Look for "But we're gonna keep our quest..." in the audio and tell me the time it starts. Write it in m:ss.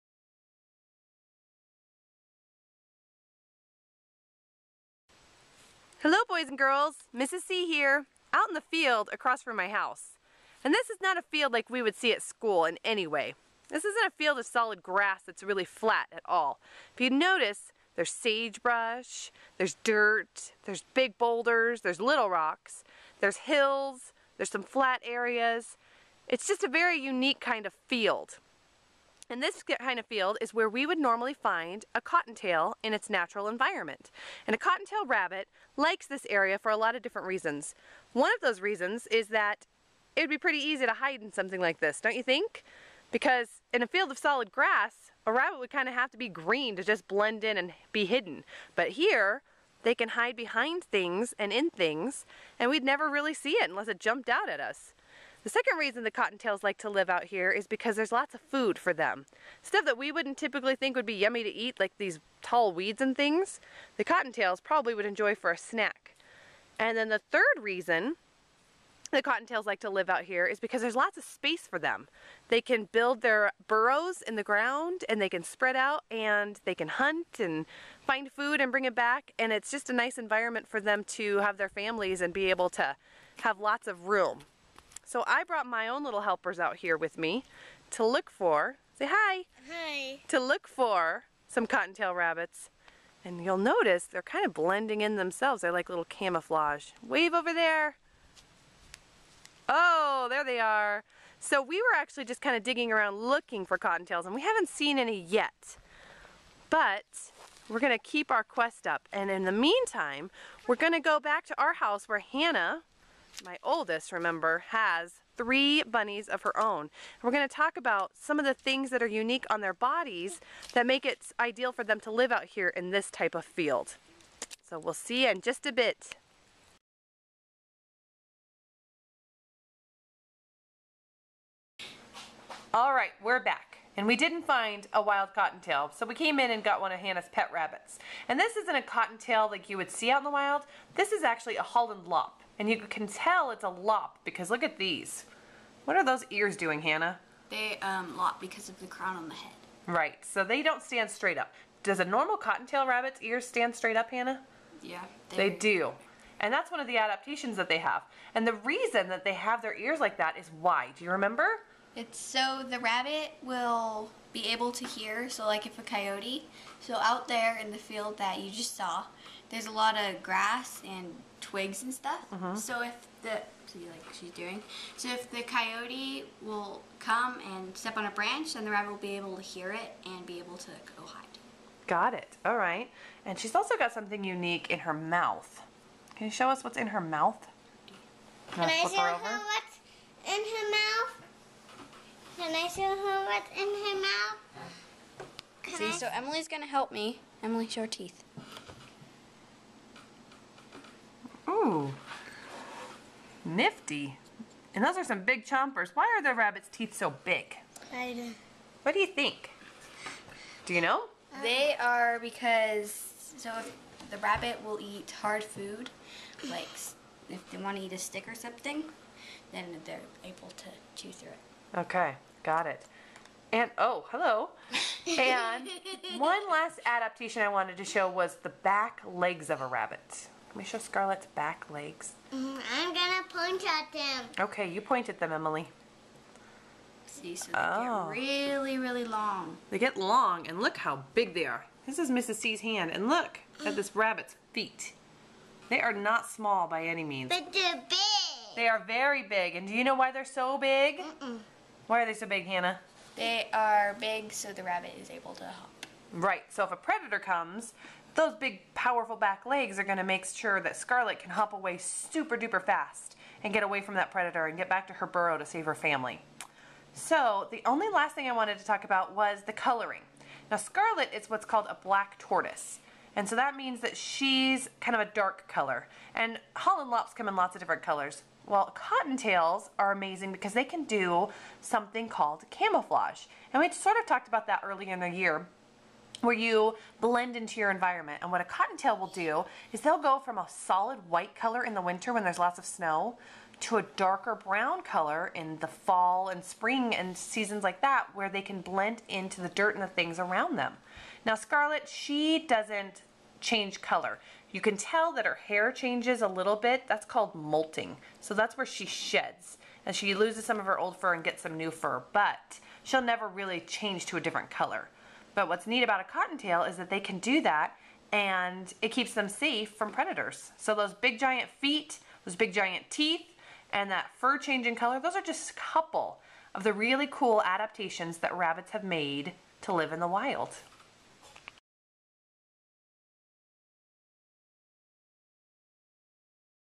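1:46.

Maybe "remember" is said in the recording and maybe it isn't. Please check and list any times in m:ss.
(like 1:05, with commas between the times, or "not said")
1:54, 2:41.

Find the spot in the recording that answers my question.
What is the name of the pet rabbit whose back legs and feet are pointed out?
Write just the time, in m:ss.
3:50.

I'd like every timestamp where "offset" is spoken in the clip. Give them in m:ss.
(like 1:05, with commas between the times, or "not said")
not said.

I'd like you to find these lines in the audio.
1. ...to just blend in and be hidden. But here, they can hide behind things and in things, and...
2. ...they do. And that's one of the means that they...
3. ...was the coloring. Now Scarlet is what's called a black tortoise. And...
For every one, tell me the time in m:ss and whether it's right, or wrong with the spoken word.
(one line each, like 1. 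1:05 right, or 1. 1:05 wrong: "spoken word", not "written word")
1. 0:46 right
2. 2:35 wrong: "adaptations", not "means"
3. 4:29 right.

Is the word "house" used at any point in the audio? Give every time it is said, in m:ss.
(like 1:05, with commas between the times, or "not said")
0:09, 1:51.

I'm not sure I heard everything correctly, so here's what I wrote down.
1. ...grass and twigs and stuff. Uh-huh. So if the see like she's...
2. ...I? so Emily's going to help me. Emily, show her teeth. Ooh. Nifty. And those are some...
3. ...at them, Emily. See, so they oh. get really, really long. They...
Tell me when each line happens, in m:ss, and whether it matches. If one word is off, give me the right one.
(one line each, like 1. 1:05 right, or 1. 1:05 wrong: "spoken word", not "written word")
1. 2:50 right
2. 3:15 right
3. 3:55 right.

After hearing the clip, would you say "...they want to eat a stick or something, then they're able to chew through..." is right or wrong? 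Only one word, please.
right.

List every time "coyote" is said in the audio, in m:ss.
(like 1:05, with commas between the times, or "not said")
2:45, 2:55.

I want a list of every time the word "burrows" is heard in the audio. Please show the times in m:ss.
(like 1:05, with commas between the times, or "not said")
1:13, 4:25.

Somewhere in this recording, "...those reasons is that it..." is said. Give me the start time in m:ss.
0:38.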